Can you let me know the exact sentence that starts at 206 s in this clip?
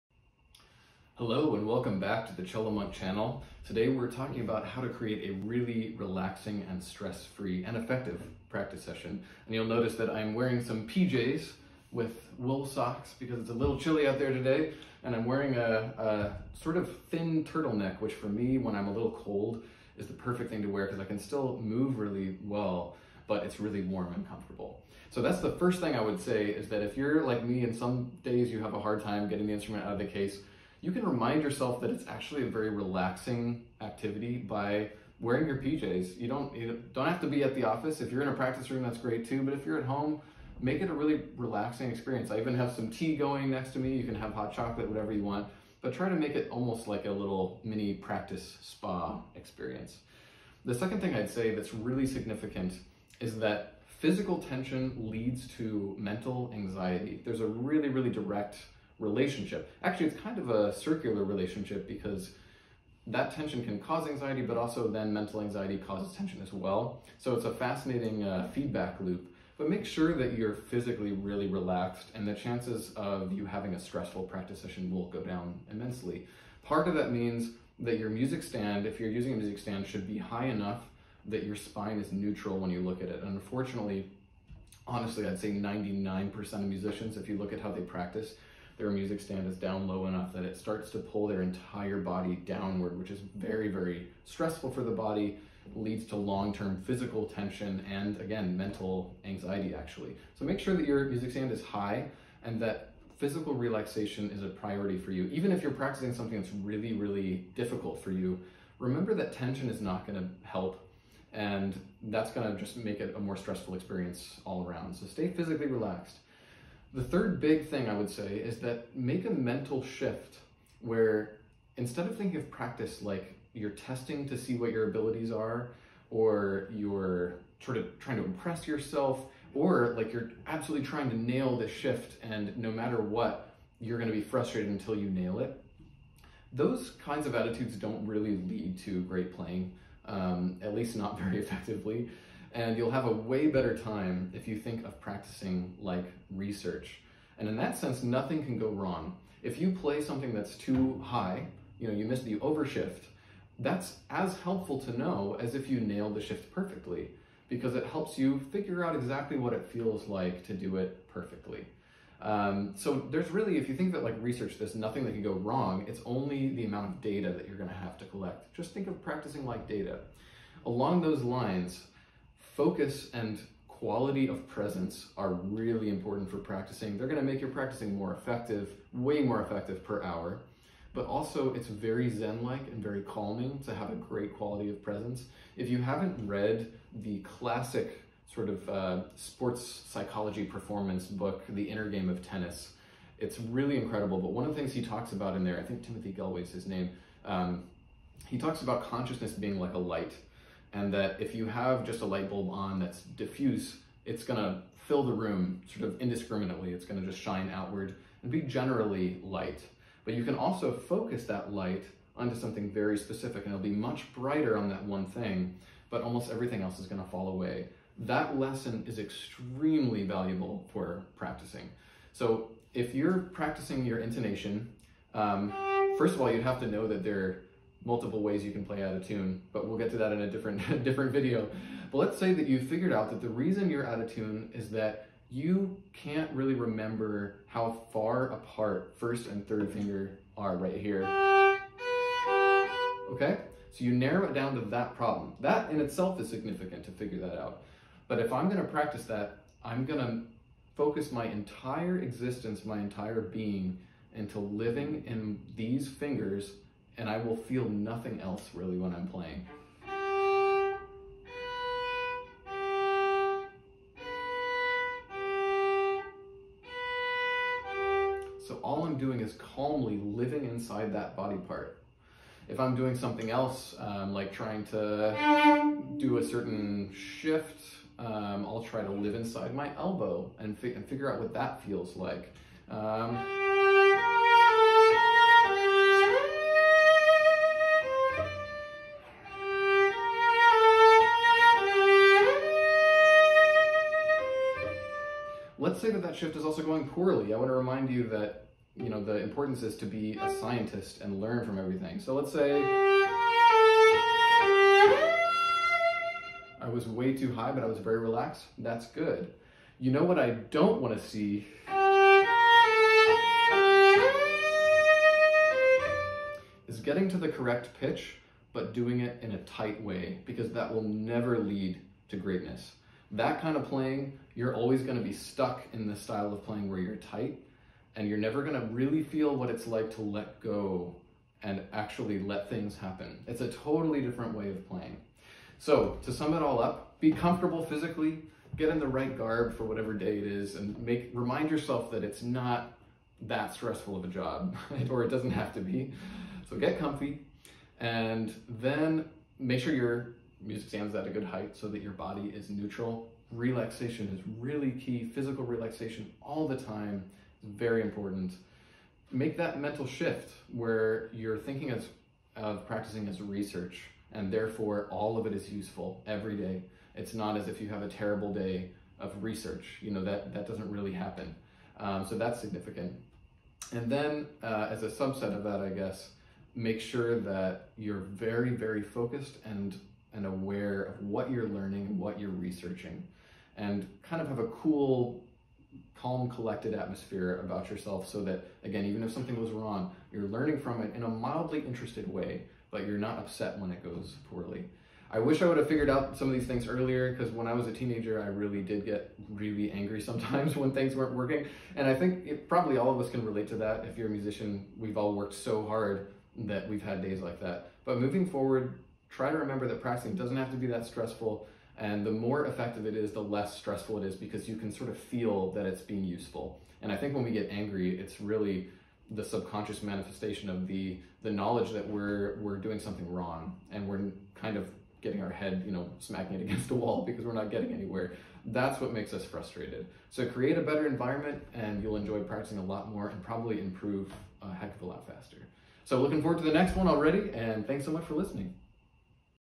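It's gonna just shine outward and be generally light.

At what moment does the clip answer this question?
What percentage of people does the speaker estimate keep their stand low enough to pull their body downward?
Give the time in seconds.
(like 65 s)
85 s.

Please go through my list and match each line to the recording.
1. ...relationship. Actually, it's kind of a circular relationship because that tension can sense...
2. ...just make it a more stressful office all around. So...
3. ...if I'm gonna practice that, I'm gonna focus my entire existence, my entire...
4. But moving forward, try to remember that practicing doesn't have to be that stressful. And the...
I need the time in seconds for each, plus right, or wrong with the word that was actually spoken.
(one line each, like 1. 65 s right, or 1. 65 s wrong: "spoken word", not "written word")
1. 59 s wrong: "cause", not "sense"
2. 112 s wrong: "experience", not "office"
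3. 248 s right
4. 407 s right.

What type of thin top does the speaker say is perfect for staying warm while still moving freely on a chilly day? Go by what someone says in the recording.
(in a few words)
Turtleneck.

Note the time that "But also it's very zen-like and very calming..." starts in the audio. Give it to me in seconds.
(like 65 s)
180 s.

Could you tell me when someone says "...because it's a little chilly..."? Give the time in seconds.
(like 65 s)
13 s.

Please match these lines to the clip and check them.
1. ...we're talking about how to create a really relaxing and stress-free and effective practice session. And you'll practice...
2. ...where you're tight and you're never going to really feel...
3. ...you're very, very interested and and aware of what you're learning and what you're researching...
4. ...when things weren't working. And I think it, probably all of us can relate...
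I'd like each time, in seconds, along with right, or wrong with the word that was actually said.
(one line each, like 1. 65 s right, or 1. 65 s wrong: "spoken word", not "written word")
1. 3 s wrong: "notice", not "practice"
2. 326 s right
3. 377 s wrong: "focused", not "interested"
4. 400 s right.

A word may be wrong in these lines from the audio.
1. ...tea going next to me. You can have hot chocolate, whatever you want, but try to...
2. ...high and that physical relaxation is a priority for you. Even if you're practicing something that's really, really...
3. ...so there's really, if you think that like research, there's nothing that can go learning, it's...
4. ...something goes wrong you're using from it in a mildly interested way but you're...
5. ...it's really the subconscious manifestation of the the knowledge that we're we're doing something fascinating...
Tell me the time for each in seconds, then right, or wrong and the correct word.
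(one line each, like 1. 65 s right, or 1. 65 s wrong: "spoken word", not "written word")
1. 42 s right
2. 101 s right
3. 162 s wrong: "wrong", not "learning"
4. 389 s wrong: "learning", not "using"
5. 417 s wrong: "wrong", not "fascinating".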